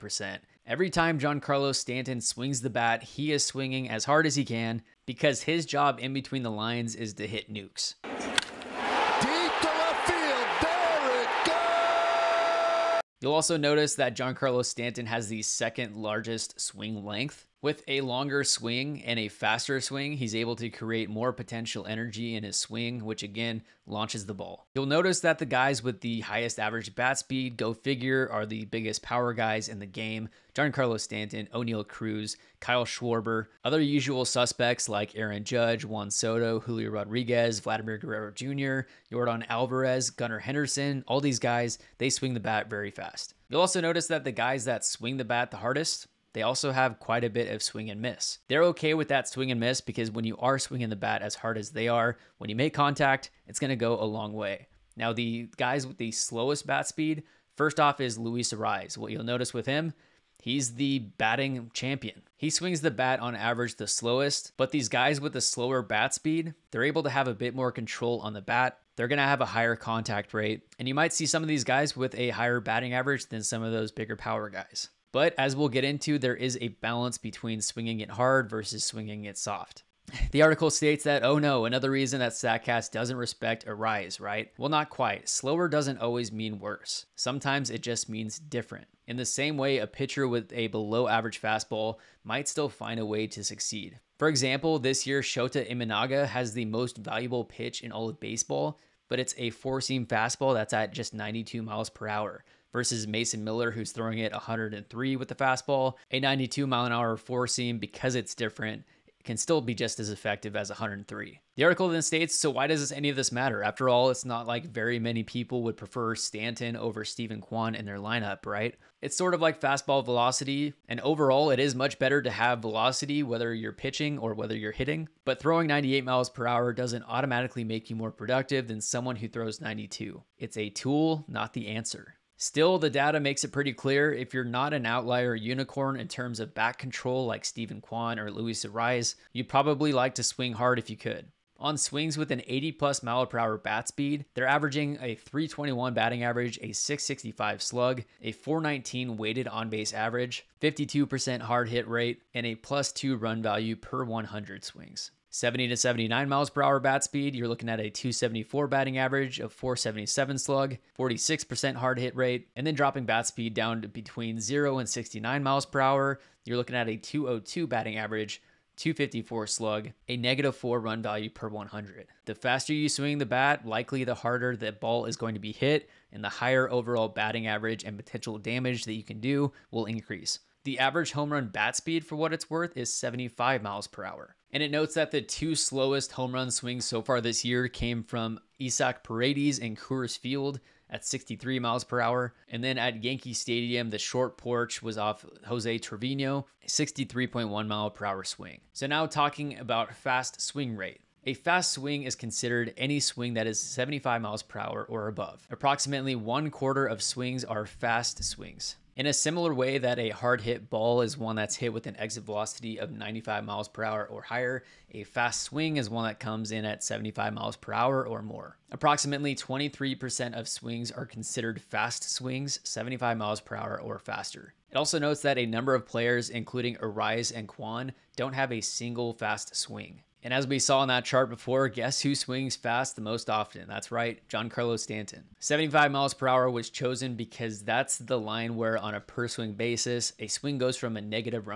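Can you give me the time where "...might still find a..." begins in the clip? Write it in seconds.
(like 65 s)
92 s.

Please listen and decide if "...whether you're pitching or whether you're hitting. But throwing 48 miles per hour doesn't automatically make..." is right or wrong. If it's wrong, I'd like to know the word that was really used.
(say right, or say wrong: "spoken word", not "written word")
wrong: "98", not "48".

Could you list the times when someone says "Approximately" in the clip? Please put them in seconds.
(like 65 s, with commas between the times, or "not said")
205 s, 218 s.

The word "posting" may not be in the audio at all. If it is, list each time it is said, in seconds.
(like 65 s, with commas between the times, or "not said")
not said.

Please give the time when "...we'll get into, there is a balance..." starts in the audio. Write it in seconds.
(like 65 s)
75 s.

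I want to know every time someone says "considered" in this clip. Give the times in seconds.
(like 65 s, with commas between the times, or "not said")
202 s, 221 s.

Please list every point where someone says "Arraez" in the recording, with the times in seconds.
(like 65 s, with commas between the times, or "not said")
58 s, 83 s, 138 s, 226 s.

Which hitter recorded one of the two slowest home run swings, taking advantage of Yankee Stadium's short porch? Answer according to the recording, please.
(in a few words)
Jose Trevino.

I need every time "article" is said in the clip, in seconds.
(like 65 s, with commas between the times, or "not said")
80 s, 111 s.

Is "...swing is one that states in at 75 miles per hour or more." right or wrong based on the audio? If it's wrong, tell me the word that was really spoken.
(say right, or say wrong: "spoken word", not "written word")
wrong: "comes", not "states".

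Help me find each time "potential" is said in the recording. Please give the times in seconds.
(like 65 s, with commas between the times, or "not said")
21 s, 177 s.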